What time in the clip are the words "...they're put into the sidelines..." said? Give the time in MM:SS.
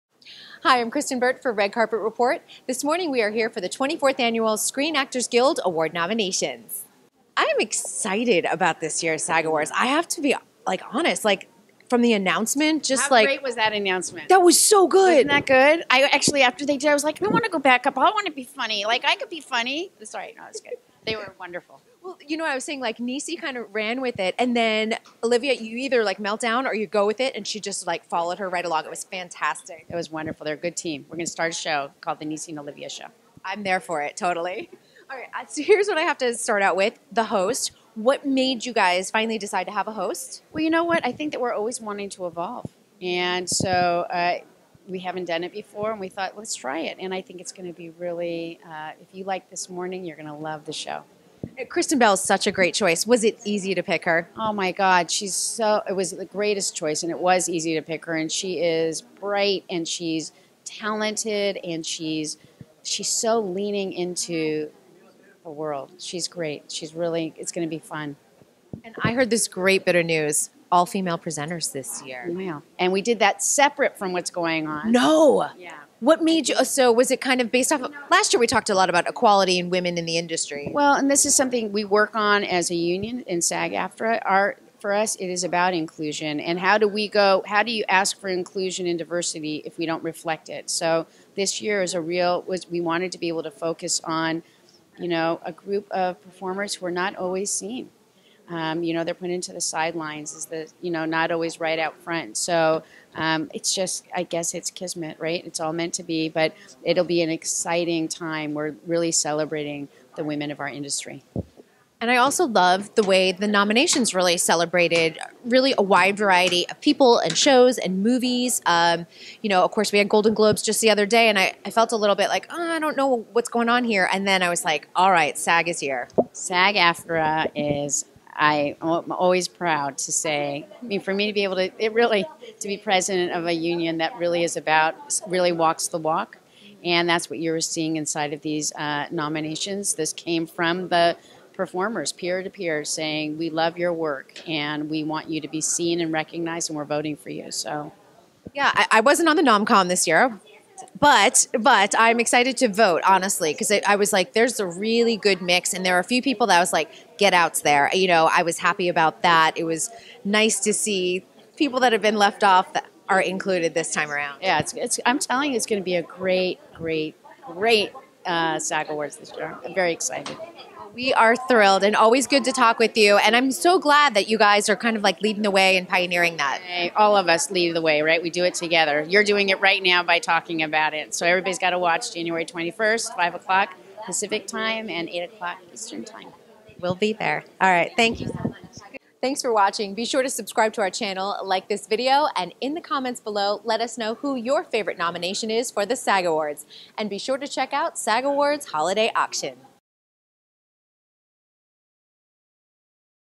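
01:39.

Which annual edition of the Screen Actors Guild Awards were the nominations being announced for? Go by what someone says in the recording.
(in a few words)
24th.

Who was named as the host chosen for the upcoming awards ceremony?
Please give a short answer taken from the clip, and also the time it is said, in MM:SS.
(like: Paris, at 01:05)
Kristen Bell, at 00:51.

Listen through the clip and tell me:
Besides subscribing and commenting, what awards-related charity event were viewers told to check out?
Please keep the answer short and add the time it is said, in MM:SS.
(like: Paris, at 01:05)
SAG Awards Holiday Auction, at 03:17.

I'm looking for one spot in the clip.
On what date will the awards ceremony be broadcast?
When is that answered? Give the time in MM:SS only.
03:02.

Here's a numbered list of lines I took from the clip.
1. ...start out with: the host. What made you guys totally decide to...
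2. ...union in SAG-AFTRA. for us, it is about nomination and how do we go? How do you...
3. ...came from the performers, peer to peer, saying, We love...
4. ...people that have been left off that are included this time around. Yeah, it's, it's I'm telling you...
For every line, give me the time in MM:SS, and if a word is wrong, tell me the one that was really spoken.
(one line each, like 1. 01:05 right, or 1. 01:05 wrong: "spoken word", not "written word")
1. 00:36 wrong: "finally", not "totally"
2. 01:22 wrong: "inclusion", not "nomination"
3. 02:20 right
4. 02:41 right.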